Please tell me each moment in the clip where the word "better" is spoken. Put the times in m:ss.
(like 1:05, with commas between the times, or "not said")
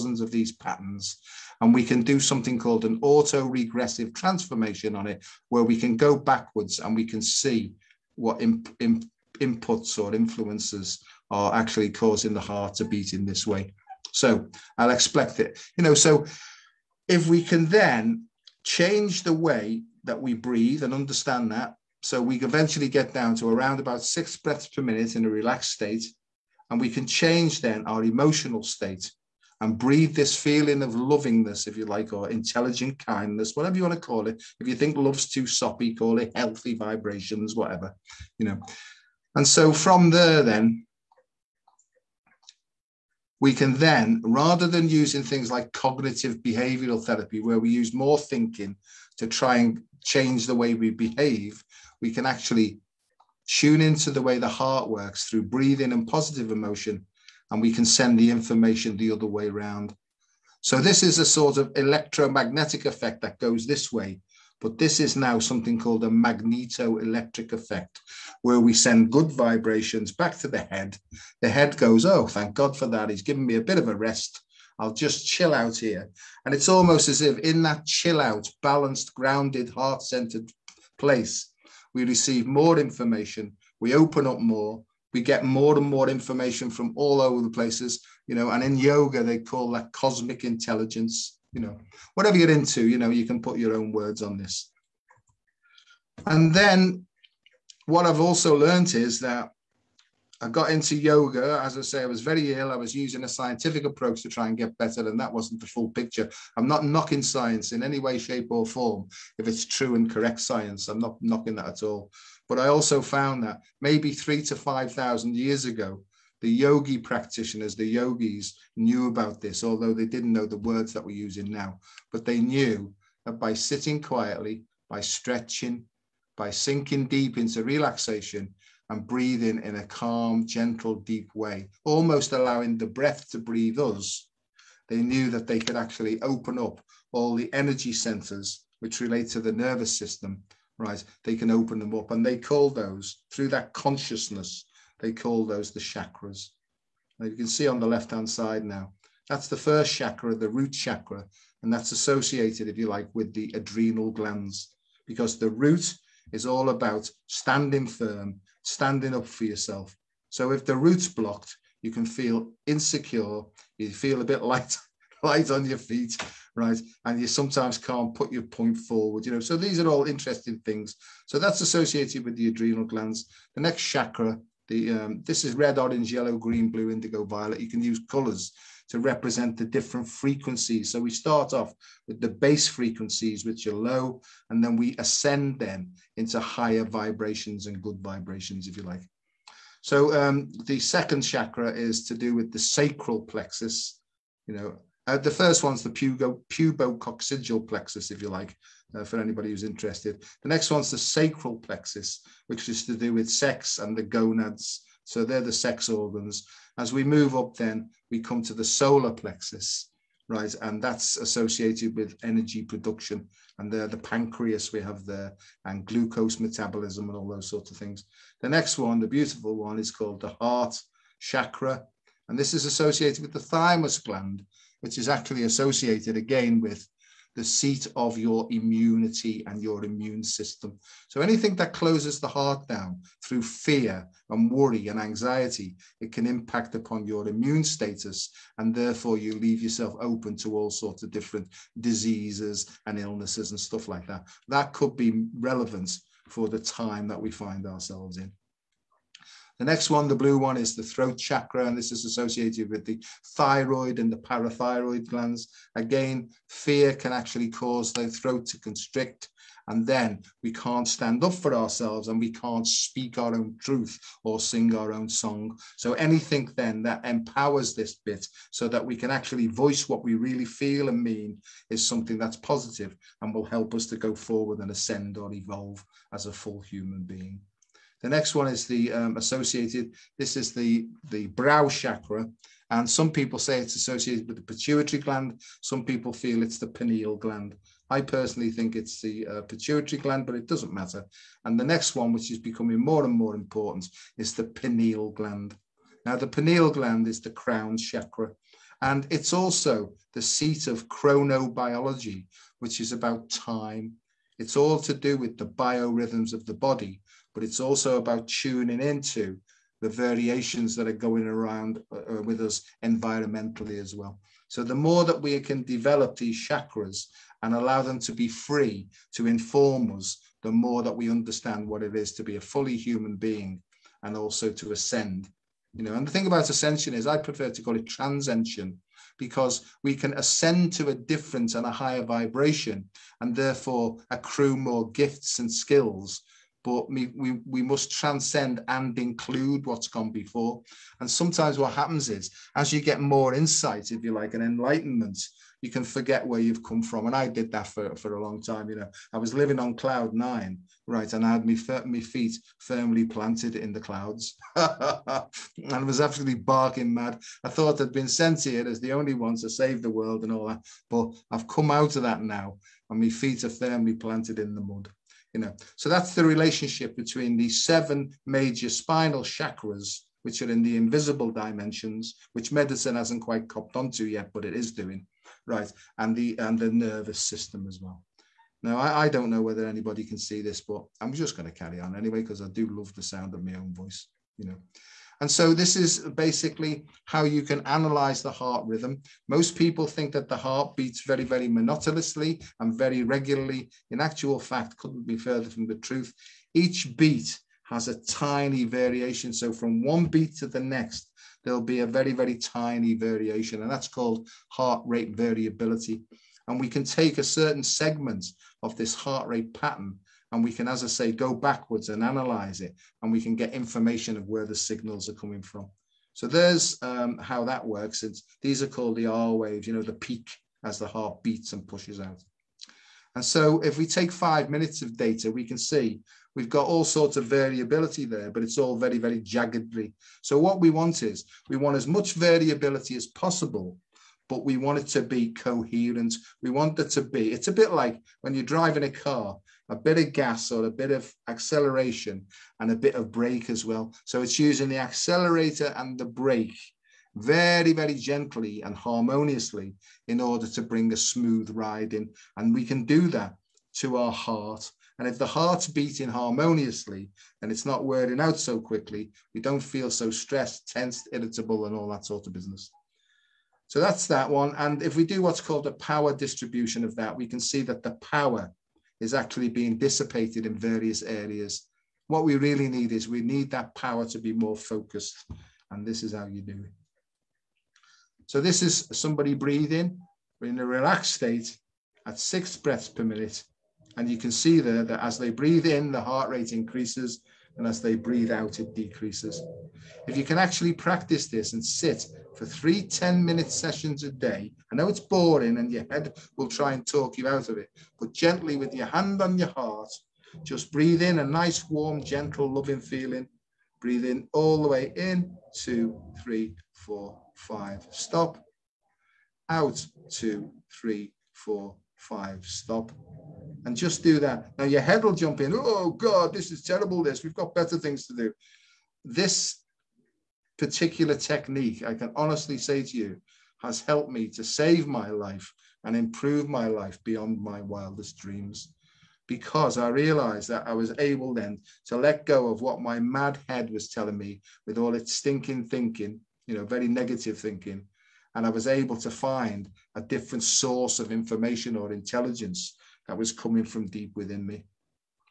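1:44, 8:37.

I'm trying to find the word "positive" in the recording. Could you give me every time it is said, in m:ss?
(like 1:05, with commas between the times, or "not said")
0:56, 4:32.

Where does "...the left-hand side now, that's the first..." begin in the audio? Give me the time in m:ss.
2:27.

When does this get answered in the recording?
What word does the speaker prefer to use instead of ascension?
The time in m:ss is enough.
5:27.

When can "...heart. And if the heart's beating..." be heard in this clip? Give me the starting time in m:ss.
7:34.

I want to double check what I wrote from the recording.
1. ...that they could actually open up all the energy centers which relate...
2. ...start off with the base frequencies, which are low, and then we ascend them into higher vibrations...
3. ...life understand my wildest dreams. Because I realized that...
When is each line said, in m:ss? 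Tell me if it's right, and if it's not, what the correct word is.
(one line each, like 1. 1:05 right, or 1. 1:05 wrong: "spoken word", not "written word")
1. 2:15 right
2. 3:01 right
3. 8:46 wrong: "beyond", not "understand".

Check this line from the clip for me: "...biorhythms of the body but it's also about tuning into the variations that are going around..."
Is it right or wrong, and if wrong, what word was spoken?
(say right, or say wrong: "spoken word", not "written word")
right.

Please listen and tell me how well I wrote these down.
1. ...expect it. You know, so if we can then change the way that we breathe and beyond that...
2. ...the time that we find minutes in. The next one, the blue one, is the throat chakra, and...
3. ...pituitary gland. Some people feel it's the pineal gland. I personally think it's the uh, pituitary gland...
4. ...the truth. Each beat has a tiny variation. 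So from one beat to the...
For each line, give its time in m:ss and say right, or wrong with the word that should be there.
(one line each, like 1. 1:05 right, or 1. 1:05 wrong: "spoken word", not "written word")
1. 0:14 wrong: "understand", not "beyond"
2. 4:06 wrong: "ourselves", not "minutes"
3. 4:44 right
4. 6:35 right.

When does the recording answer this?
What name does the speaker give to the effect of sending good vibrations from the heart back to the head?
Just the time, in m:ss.
1:06.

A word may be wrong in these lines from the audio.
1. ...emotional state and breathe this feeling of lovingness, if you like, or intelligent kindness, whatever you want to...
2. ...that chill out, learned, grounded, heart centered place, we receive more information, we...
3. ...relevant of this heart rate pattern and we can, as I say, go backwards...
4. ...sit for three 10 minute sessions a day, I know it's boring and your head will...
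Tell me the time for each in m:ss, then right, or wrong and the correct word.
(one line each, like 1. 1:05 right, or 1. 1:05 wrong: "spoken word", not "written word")
1. 0:28 right
2. 1:17 wrong: "balanced", not "learned"
3. 6:47 wrong: "segment", not "relevant"
4. 8:11 right.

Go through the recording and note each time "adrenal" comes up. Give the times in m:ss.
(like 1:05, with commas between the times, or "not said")
2:33, 2:52.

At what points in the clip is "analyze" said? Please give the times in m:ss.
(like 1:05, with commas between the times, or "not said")
6:27, 6:52.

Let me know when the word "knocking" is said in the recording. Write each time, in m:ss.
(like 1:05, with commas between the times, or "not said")
1:46, 1:51.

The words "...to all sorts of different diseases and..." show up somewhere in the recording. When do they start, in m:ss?
4:00.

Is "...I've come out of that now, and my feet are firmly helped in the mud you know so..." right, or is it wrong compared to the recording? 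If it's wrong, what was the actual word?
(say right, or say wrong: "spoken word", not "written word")
wrong: "planted", not "helped".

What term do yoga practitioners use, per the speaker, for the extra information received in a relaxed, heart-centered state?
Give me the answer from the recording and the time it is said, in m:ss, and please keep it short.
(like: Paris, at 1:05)
cosmic intelligence, at 1:29.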